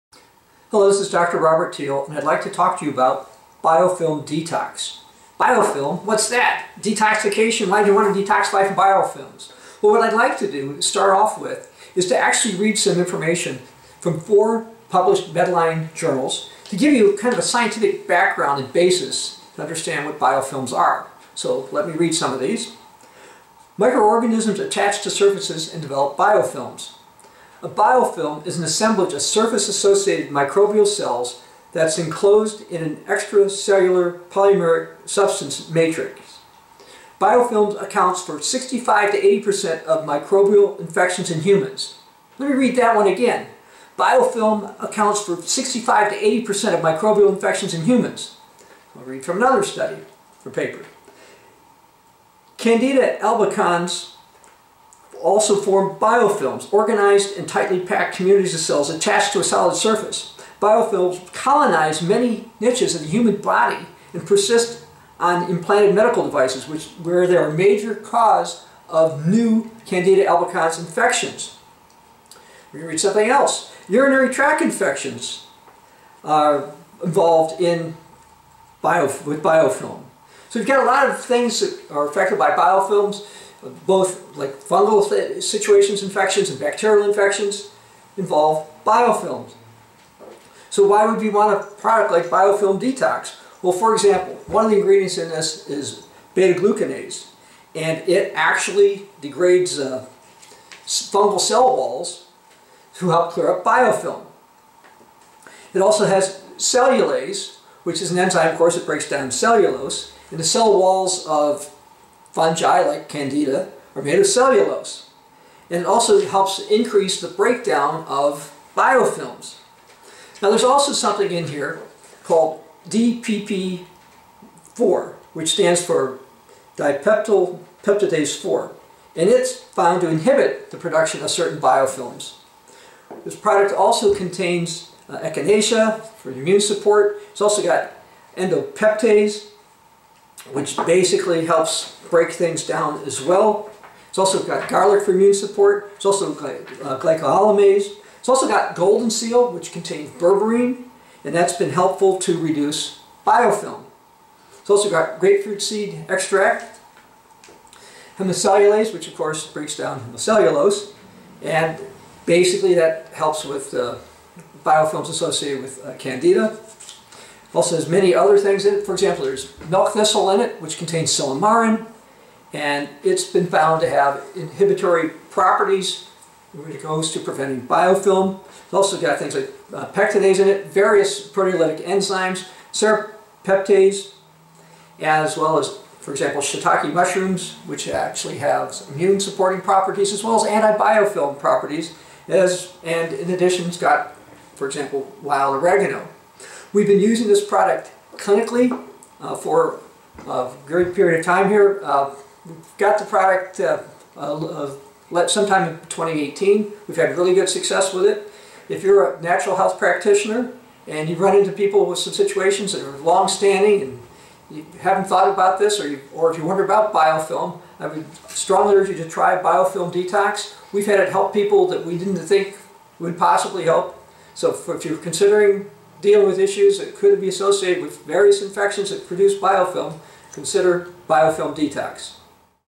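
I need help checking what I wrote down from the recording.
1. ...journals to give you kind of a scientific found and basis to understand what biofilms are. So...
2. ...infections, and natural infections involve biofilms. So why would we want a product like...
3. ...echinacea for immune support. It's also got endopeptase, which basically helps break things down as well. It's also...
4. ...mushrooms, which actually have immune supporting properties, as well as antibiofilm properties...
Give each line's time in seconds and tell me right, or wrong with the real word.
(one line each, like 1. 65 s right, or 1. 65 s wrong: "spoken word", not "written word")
1. 15 s wrong: "background", not "found"
2. 86 s wrong: "bacterial", not "natural"
3. 135 s right
4. 186 s right.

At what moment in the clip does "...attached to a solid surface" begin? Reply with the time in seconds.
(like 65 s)
58 s.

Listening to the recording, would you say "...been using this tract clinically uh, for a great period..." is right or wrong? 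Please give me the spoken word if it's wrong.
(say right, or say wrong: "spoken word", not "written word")
wrong: "product", not "tract".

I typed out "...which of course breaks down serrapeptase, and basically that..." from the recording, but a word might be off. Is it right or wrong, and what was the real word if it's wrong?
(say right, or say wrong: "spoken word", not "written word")
wrong: "hemicellulose", not "serrapeptase".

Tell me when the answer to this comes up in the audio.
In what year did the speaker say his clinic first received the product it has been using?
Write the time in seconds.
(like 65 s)
205 s.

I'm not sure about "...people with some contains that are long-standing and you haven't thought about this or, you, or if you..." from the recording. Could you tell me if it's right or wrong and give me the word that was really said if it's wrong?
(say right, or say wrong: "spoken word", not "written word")
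wrong: "situations", not "contains".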